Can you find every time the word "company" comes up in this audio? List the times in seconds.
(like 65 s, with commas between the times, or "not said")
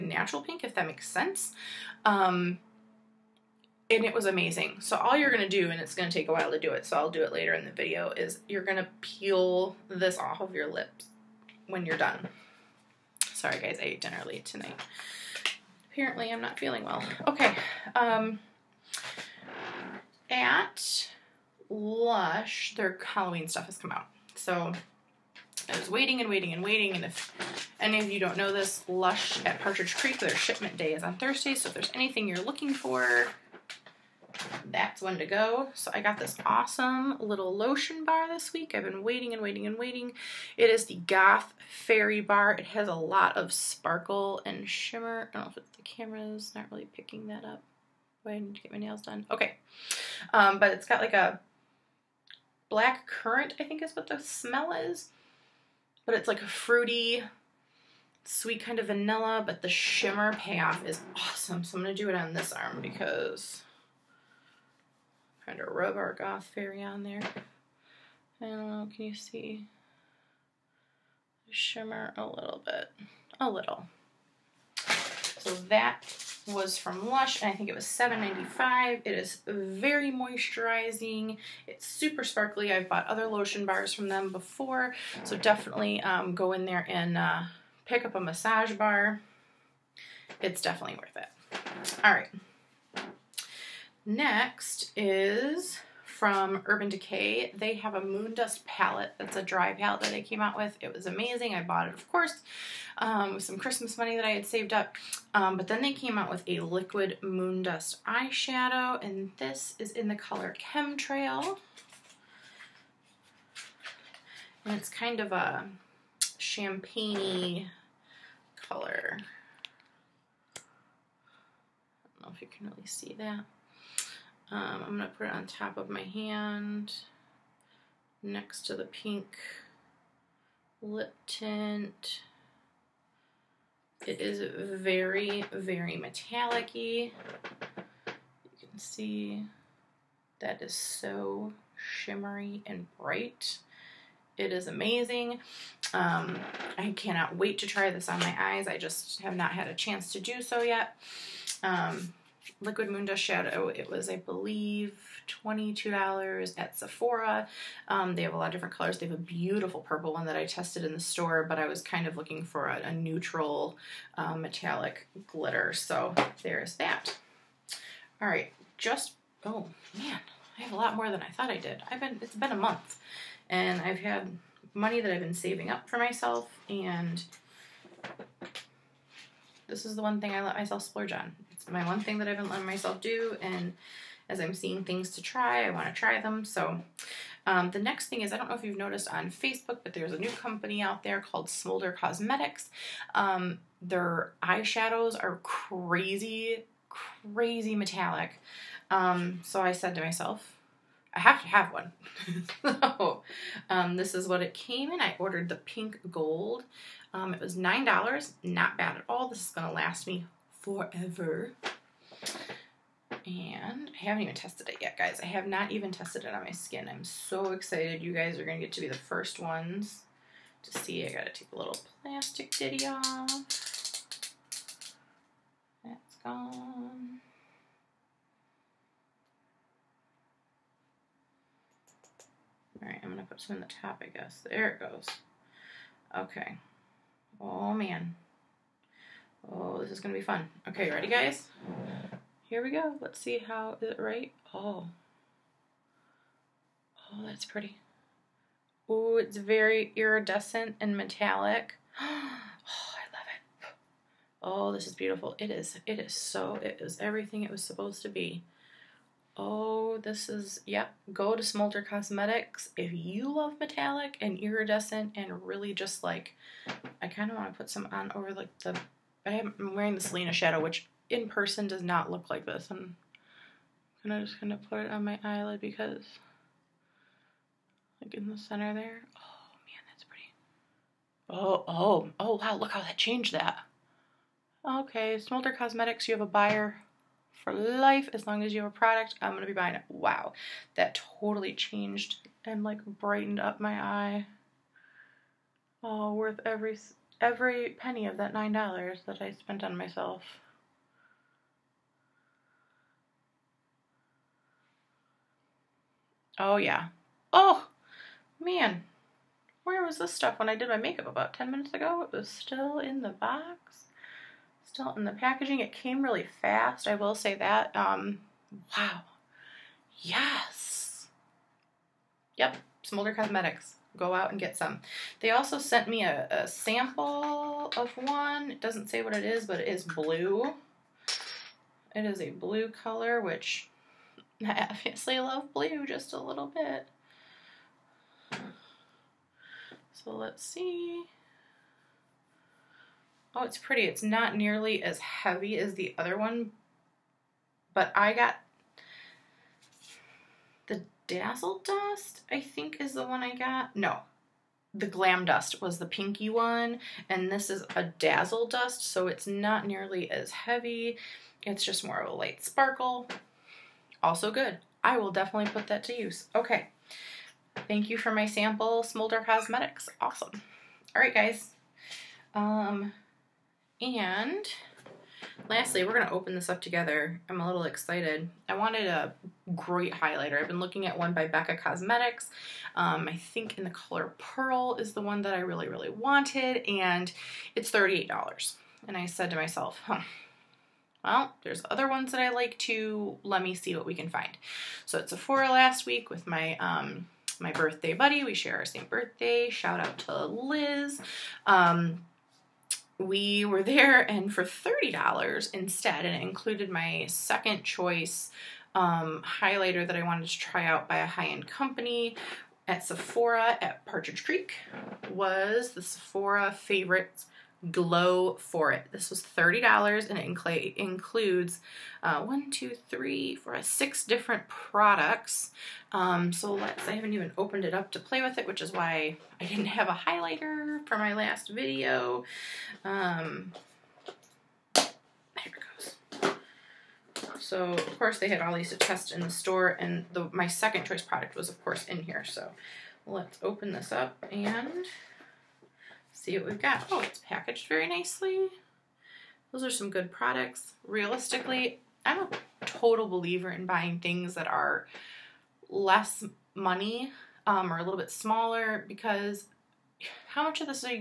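190 s, 411 s.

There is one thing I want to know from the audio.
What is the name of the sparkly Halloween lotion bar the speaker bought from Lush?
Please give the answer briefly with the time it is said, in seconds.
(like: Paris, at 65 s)
Goth Fairy Bar, at 40 s.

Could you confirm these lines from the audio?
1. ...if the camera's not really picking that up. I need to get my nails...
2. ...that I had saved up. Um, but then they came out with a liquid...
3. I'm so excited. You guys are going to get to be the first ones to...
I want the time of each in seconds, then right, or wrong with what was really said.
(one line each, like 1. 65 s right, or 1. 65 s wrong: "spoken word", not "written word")
1. 45 s right
2. 104 s right
3. 216 s right.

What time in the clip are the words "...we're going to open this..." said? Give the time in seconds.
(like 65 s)
375 s.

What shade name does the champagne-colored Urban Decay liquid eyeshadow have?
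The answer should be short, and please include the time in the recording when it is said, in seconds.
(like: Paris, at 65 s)
Chemtrail, at 110 s.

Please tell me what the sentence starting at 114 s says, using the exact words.
And it's kind of a champagne color.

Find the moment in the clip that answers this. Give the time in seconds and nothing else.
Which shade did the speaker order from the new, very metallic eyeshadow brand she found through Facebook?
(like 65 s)
205 s.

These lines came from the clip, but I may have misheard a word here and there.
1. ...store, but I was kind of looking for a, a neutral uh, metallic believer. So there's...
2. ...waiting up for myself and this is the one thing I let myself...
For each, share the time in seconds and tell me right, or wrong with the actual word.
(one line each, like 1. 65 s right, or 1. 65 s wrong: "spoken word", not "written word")
1. 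160 s wrong: "glitter", not "believer"
2. 175 s wrong: "saving", not "waiting".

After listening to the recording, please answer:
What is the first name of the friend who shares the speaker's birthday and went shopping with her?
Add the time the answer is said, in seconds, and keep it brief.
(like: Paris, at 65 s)
Liz, at 400 s.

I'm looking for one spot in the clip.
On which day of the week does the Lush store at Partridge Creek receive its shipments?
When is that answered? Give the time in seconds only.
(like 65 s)
31 s.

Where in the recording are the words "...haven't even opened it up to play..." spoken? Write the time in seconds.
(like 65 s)
426 s.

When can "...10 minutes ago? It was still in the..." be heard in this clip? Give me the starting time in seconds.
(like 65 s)
311 s.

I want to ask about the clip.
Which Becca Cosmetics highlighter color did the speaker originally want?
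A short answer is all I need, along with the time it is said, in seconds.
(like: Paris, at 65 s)
Pearl, at 384 s.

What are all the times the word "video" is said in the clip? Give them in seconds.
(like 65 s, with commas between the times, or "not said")
7 s, 431 s.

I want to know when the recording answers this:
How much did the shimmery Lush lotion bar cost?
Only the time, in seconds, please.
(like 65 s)
77 s.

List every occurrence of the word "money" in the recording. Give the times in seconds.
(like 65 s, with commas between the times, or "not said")
103 s, 174 s, 456 s.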